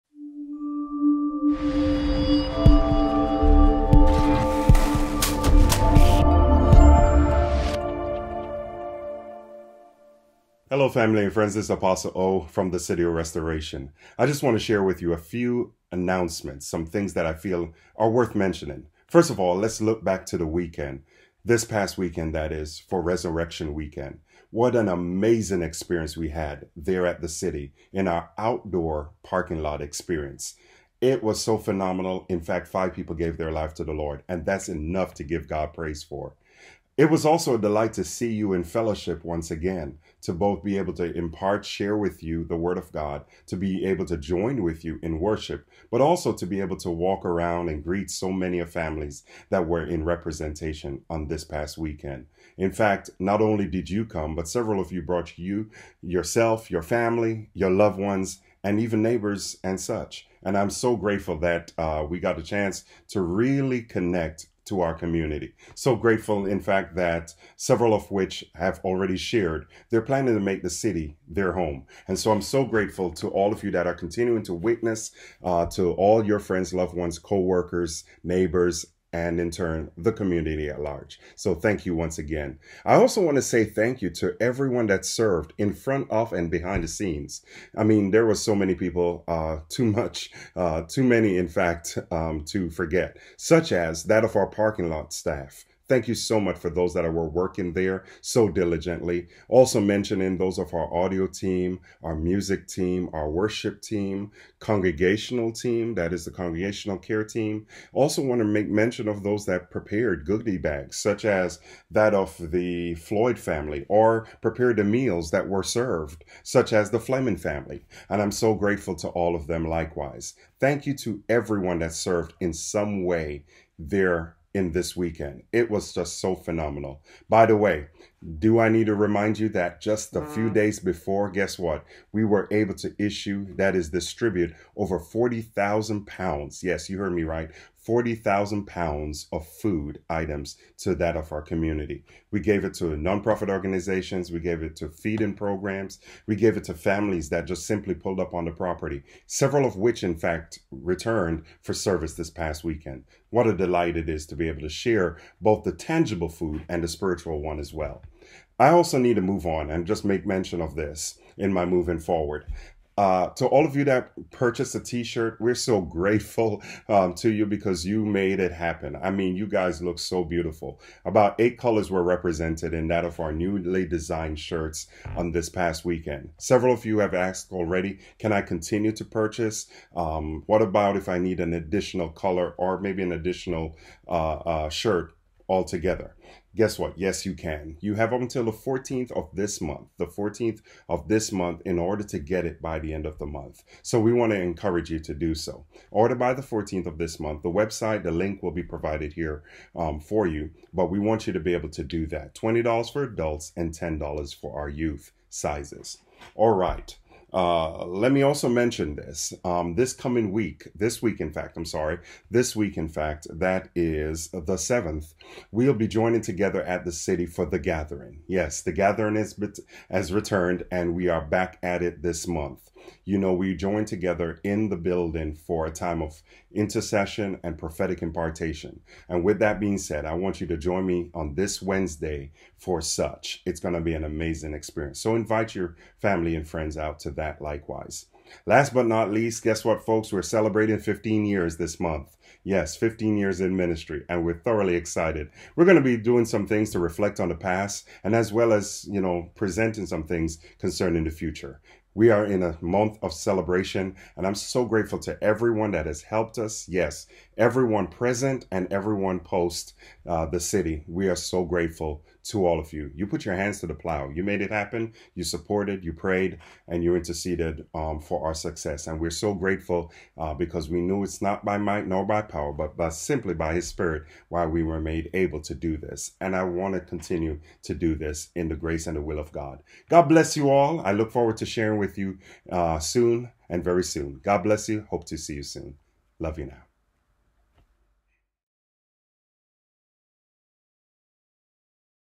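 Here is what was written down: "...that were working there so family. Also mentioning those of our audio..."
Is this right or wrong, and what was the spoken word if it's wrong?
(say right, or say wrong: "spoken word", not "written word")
wrong: "diligently", not "family".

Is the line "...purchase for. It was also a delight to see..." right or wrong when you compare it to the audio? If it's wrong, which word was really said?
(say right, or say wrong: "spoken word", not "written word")
wrong: "praise", not "purchase".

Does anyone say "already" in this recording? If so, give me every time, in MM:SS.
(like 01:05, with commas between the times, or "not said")
01:08, 02:57.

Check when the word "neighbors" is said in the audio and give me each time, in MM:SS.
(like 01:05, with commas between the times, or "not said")
00:59, 01:18.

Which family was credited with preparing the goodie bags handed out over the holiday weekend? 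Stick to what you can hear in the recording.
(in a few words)
Floyd family.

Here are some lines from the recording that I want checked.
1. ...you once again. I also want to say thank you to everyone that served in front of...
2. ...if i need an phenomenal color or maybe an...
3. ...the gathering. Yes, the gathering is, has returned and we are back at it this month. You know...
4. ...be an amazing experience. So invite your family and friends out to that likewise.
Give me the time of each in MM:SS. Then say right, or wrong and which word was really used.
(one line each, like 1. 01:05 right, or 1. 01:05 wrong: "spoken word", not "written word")
1. 01:21 right
2. 03:00 wrong: "additional", not "phenomenal"
3. 03:37 right
4. 03:53 right.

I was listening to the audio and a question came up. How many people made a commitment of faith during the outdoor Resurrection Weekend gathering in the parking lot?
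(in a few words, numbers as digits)
5.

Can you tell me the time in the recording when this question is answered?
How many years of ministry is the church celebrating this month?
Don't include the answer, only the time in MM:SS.
04:02.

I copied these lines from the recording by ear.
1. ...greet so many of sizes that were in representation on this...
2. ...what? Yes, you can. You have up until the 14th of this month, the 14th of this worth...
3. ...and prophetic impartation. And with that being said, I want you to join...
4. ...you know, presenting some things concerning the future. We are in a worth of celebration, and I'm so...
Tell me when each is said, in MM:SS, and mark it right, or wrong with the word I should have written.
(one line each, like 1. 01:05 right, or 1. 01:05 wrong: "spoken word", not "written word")
1. 00:47 wrong: "families", not "sizes"
2. 03:06 wrong: "month", not "worth"
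3. 03:47 right
4. 04:08 wrong: "month", not "worth".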